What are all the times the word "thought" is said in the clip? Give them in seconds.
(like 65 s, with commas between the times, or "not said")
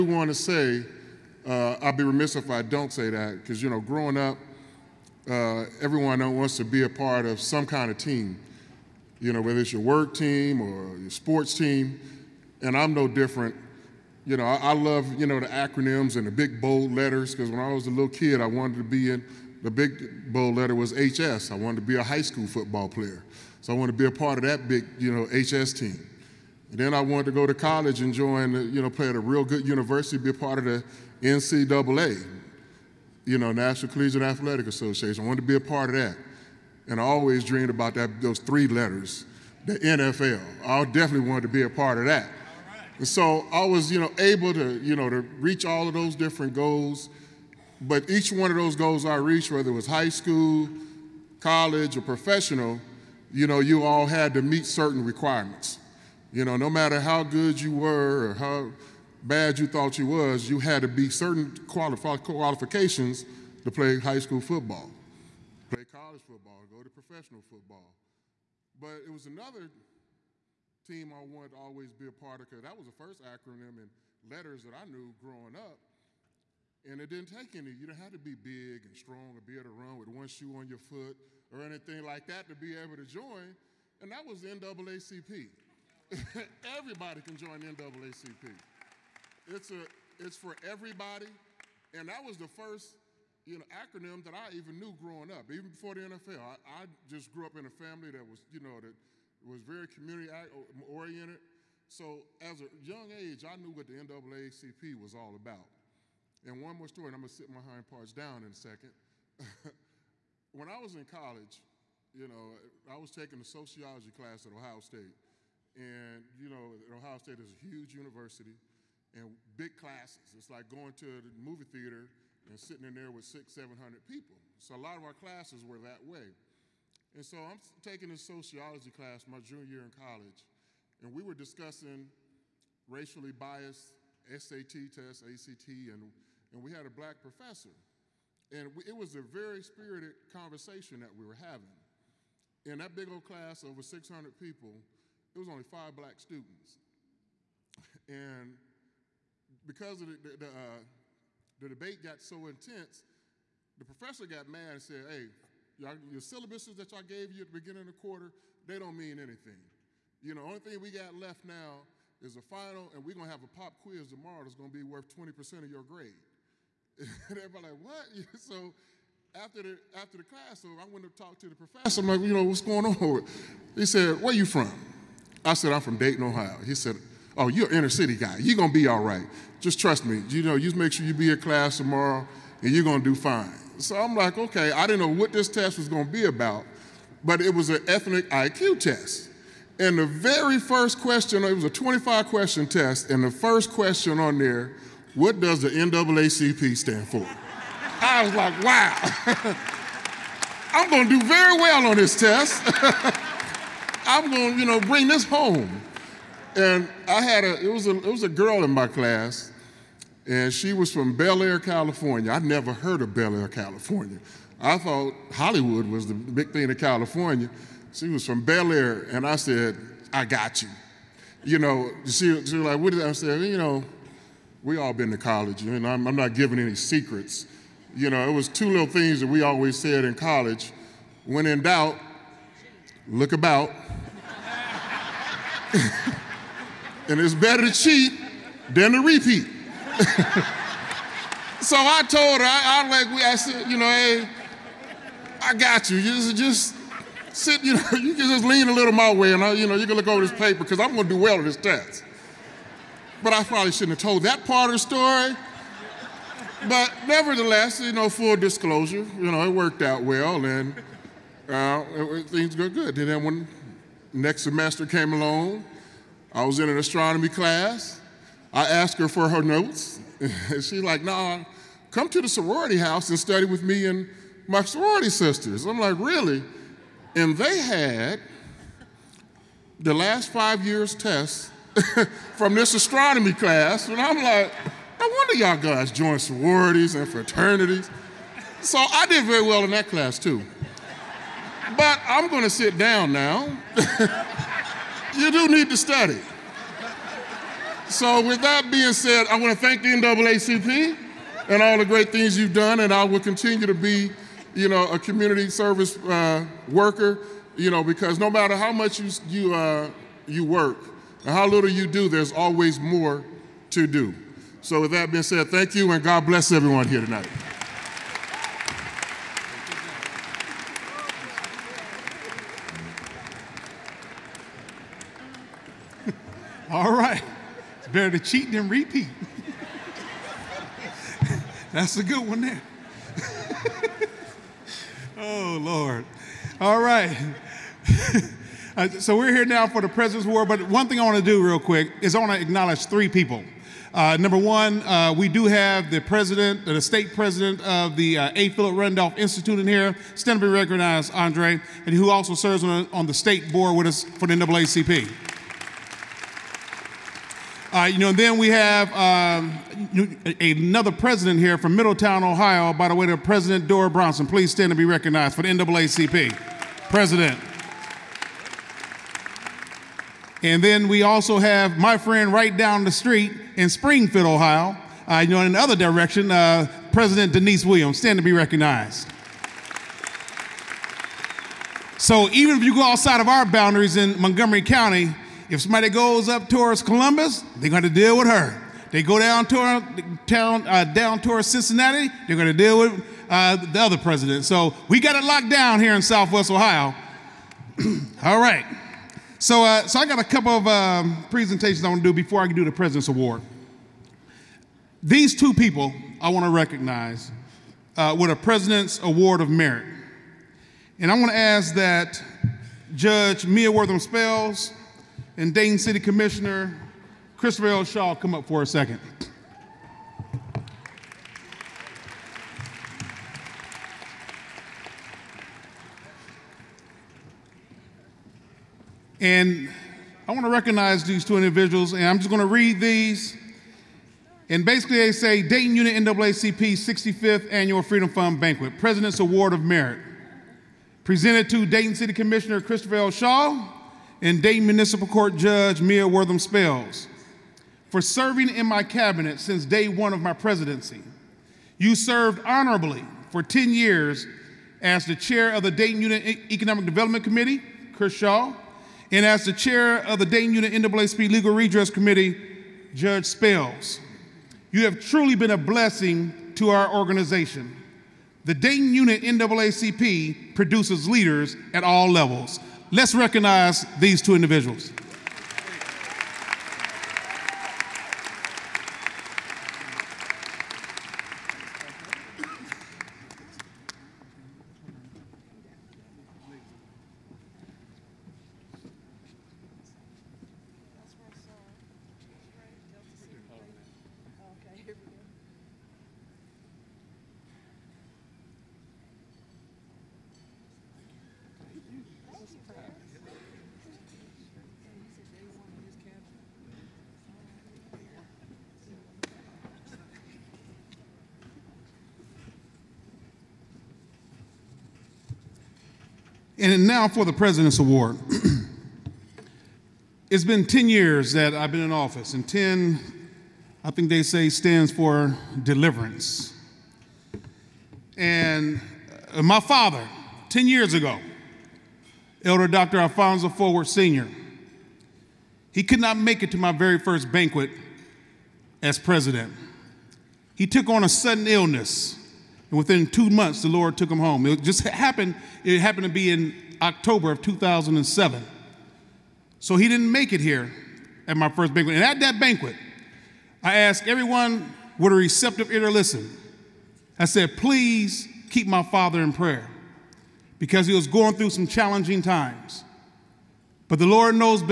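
59 s, 214 s.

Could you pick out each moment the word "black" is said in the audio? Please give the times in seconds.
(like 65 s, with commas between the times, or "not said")
136 s, 145 s.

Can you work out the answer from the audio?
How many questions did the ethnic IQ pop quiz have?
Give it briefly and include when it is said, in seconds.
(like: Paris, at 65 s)
25, at 191 s.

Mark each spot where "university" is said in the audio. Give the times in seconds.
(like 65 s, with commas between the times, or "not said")
29 s, 117 s.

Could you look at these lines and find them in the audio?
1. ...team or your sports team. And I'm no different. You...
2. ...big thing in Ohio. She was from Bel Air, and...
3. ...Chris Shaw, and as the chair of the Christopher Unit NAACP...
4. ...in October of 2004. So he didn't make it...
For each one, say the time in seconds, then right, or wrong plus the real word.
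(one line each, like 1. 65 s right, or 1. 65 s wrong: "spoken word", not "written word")
1. 10 s right
2. 216 s wrong: "California", not "Ohio"
3. 457 s wrong: "Dayton", not "Christopher"
4. 546 s wrong: "2007", not "2004".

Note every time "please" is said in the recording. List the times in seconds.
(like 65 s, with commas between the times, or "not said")
364 s, 557 s.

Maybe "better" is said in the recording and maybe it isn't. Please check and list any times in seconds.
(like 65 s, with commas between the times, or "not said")
237 s, 327 s.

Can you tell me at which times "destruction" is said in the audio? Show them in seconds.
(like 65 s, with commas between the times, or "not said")
not said.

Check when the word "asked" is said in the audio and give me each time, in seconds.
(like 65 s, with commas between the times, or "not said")
268 s, 553 s.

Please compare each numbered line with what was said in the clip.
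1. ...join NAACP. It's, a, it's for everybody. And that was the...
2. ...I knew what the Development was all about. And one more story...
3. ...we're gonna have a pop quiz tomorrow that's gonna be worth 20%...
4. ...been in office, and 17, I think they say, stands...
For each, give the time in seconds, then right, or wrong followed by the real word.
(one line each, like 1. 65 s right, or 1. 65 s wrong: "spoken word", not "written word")
1. 87 s right
2. 103 s wrong: "NAACP", not "Development"
3. 163 s right
4. 521 s wrong: "10", not "17".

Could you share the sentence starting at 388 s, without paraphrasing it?
They go down toward, uh, down towards Cincinnati, they're going to deal with uh, the other president.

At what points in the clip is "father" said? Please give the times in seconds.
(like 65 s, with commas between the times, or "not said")
529 s, 558 s.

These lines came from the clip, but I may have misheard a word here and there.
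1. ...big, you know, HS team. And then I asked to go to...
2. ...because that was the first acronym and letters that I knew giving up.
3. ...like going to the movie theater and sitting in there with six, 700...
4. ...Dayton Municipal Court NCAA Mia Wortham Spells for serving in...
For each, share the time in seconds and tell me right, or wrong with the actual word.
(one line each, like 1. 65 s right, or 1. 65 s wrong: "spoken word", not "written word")
1. 24 s wrong: "wanted", not "asked"
2. 72 s wrong: "growing", not "giving"
3. 120 s right
4. 444 s wrong: "Judge", not "NCAA".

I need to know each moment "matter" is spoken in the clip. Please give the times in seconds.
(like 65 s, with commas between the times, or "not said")
56 s, 308 s.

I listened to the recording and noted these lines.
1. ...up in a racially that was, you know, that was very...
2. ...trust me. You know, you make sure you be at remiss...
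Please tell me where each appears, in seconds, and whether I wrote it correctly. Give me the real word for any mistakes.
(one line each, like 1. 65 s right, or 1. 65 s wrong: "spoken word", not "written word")
1. 97 s wrong: "family", not "racially"
2. 179 s wrong: "class", not "remiss".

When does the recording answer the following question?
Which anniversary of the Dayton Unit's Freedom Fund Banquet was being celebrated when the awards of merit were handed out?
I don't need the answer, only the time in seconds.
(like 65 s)
436 s.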